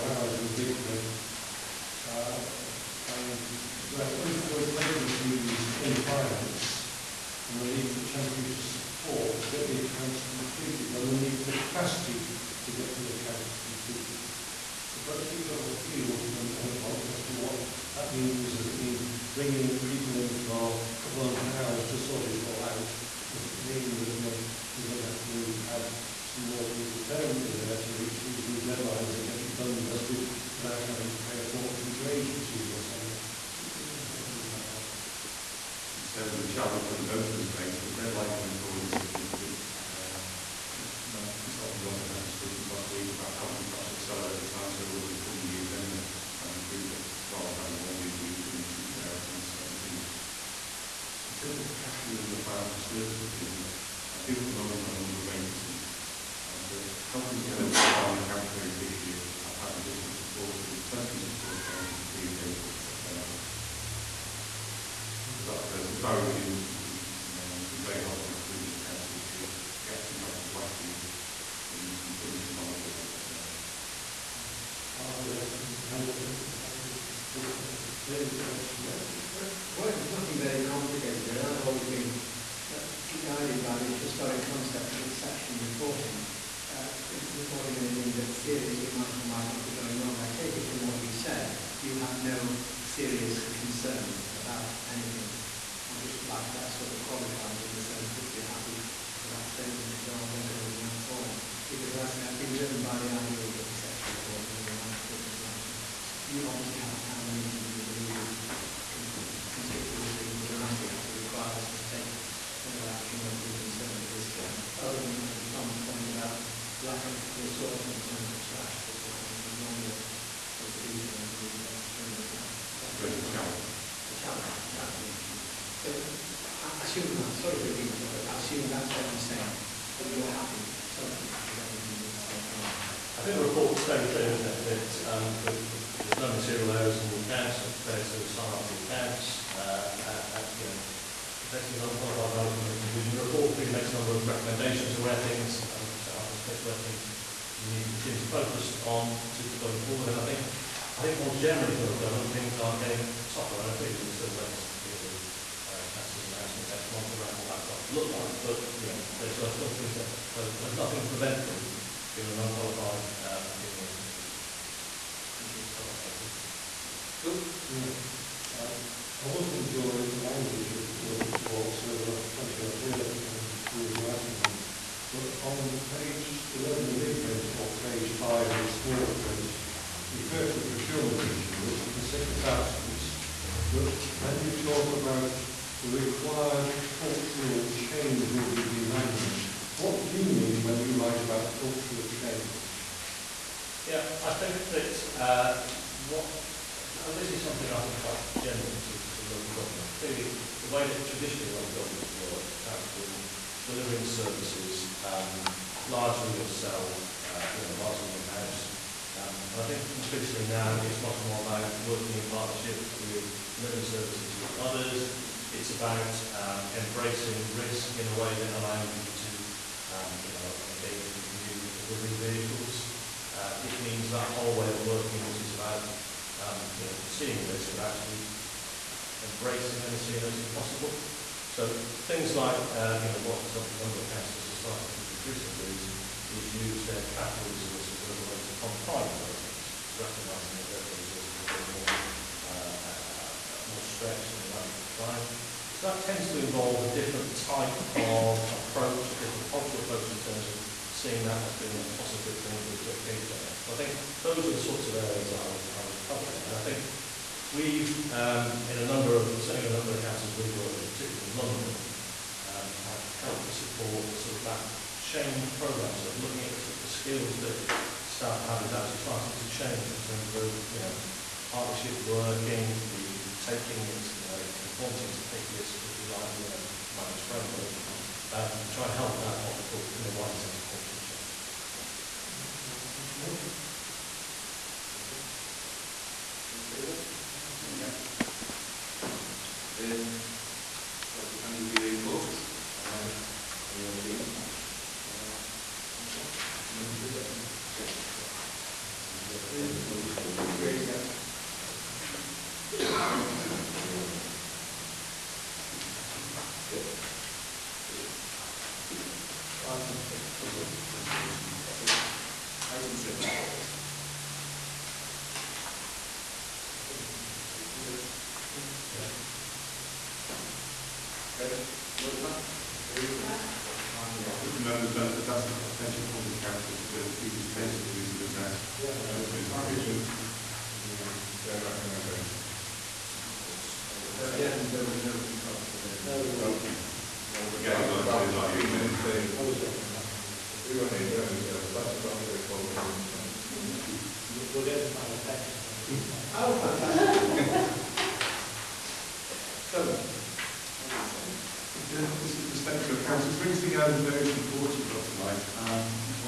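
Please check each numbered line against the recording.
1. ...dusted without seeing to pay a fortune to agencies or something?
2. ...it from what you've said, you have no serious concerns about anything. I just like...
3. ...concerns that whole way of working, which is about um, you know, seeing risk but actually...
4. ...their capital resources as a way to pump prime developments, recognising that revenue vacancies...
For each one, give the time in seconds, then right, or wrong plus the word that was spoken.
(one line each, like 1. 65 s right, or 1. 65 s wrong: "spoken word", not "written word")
1. 29 s wrong: "having", not "seeing"
2. 90 s right
3. 223 s wrong: "means", not "concerns"
4. 236 s wrong: "resources", not "vacancies".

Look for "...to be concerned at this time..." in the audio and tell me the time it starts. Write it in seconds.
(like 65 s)
113 s.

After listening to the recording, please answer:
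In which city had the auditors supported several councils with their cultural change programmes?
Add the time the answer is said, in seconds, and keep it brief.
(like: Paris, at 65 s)
London, at 261 s.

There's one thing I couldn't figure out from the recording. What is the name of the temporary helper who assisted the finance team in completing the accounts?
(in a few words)
Barry Williams.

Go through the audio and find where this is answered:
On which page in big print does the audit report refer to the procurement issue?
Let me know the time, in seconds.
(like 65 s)
175 s.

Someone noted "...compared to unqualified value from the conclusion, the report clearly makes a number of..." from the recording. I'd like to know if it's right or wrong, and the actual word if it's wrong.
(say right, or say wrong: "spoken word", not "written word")
right.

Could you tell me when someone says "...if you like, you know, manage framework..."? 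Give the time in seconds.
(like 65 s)
275 s.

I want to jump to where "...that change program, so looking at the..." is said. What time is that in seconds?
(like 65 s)
264 s.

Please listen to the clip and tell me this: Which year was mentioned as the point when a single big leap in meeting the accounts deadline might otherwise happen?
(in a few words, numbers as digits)
2017.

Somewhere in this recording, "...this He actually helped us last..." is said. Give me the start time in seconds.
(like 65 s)
69 s.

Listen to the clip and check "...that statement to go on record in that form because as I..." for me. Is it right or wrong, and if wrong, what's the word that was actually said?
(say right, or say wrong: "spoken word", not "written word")
right.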